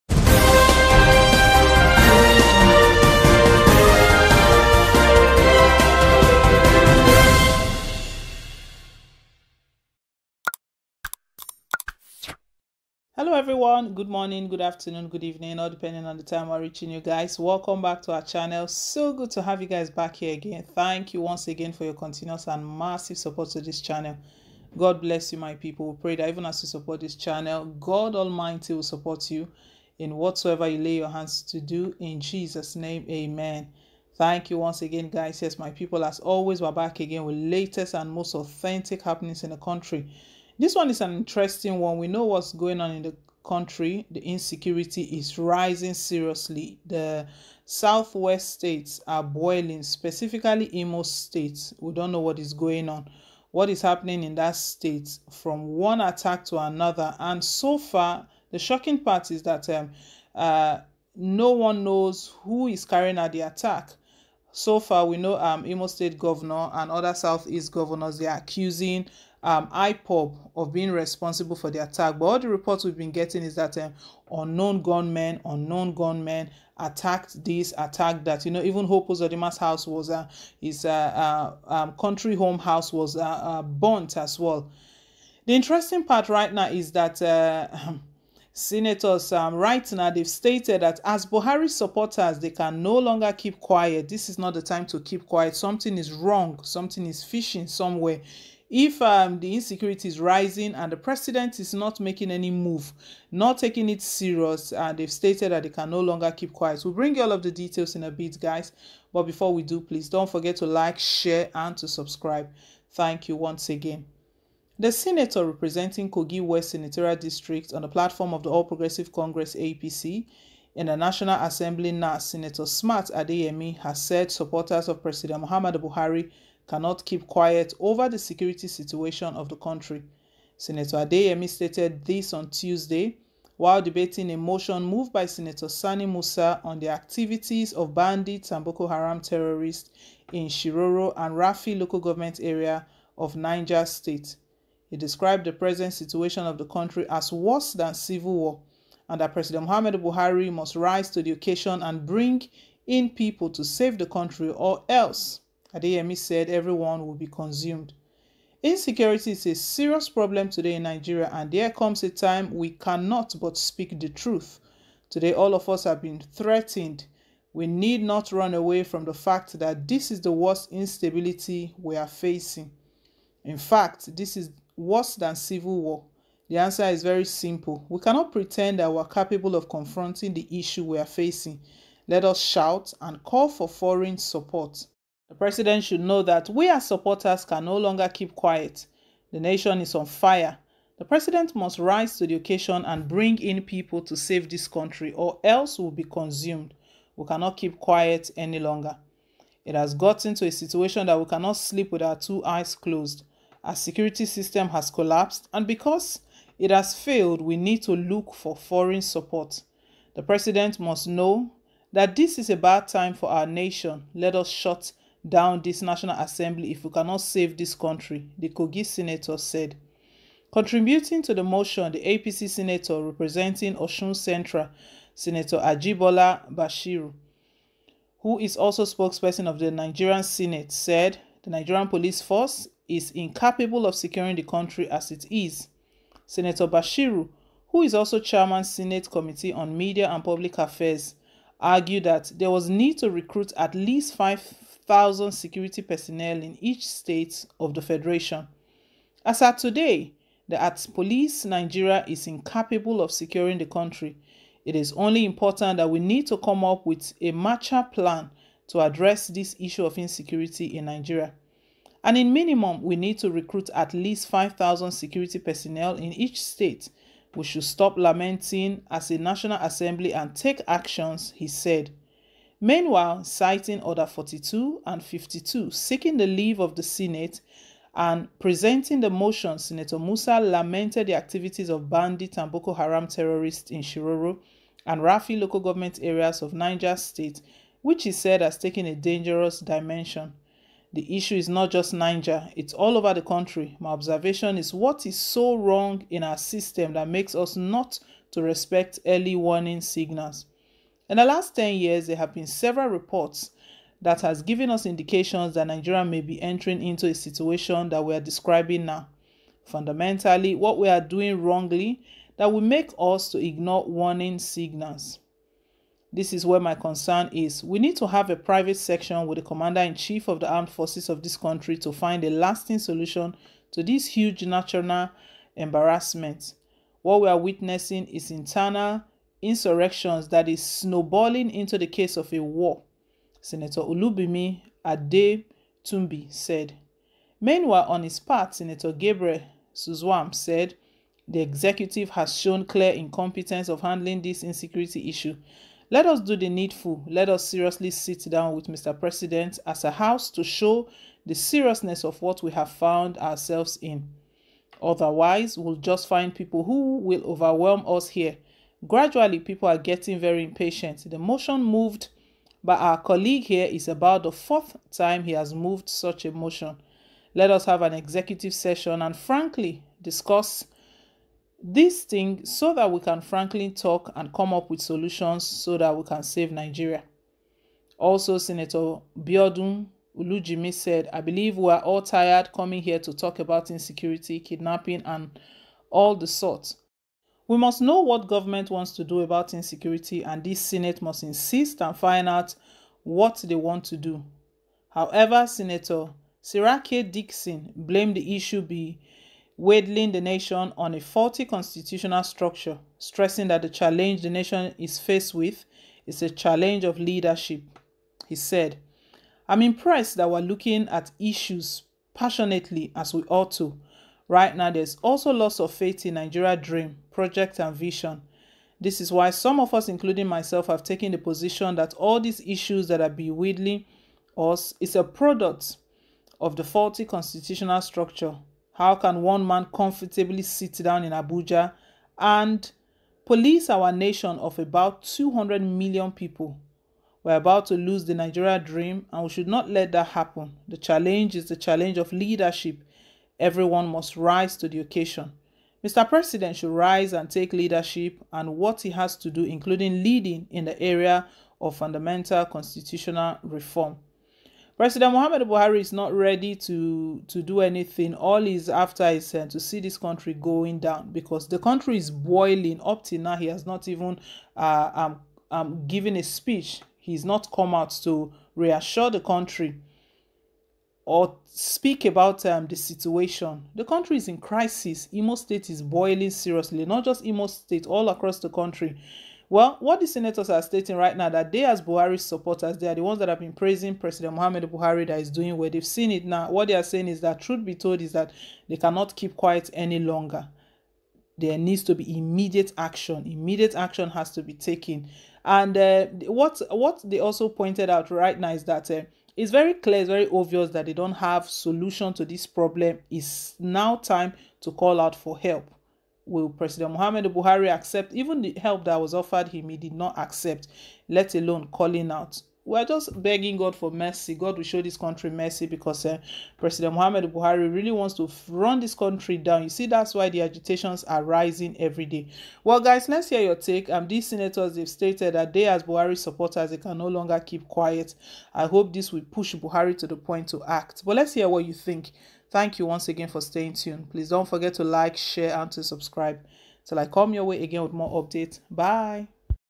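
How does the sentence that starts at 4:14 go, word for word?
It is only important that we need to come up with a Marshall plan to address this issue of insecurity in Nigeria.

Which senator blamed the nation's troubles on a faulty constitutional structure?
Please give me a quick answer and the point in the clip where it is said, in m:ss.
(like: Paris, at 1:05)
Seriake Dickson, at 6:36.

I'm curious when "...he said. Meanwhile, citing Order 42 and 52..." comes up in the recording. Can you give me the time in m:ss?
4:31.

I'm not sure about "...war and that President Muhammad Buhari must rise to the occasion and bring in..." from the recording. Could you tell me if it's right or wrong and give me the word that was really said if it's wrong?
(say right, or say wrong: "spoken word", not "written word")
right.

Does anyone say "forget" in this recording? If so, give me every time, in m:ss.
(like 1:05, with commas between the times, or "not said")
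1:50, 8:54.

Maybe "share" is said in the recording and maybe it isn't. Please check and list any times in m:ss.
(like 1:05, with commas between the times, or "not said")
1:50, 8:55.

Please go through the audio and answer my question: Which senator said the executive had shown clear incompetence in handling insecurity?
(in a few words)
Gabriel Suswam.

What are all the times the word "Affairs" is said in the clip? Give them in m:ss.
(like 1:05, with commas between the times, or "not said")
4:00.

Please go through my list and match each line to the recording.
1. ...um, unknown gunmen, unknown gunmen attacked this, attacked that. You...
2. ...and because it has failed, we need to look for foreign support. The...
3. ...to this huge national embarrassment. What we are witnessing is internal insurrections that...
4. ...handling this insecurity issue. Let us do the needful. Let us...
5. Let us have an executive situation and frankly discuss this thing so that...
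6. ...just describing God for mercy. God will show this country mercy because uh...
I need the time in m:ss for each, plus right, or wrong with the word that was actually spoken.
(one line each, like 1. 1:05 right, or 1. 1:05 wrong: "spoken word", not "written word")
1. 1:13 right
2. 3:25 right
3. 5:23 right
4. 5:43 right
5. 6:07 wrong: "session", not "situation"
6. 8:32 wrong: "begging", not "describing".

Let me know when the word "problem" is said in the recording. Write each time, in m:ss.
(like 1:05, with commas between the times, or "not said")
2:40, 8:22.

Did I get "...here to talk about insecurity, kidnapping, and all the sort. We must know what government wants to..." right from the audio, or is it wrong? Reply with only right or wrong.
right.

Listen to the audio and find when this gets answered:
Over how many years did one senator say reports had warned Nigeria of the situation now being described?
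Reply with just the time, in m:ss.
5:01.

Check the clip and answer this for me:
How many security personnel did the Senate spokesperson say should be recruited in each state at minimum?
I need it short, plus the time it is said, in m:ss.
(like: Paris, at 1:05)
5,000, at 4:24.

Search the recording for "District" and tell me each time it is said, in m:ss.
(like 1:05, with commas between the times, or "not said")
1:57.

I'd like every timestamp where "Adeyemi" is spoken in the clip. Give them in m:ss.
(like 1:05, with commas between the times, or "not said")
2:03, 2:11, 2:35.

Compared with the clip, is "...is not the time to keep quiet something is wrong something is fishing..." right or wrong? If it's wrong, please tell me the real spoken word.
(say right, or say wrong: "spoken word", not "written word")
right.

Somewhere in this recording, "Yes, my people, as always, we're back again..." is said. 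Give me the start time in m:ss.
0:35.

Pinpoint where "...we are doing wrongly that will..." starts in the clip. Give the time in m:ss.
5:10.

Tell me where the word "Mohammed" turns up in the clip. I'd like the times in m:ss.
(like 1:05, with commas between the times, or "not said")
8:04, 8:26.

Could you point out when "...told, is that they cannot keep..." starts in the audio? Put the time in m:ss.
8:07.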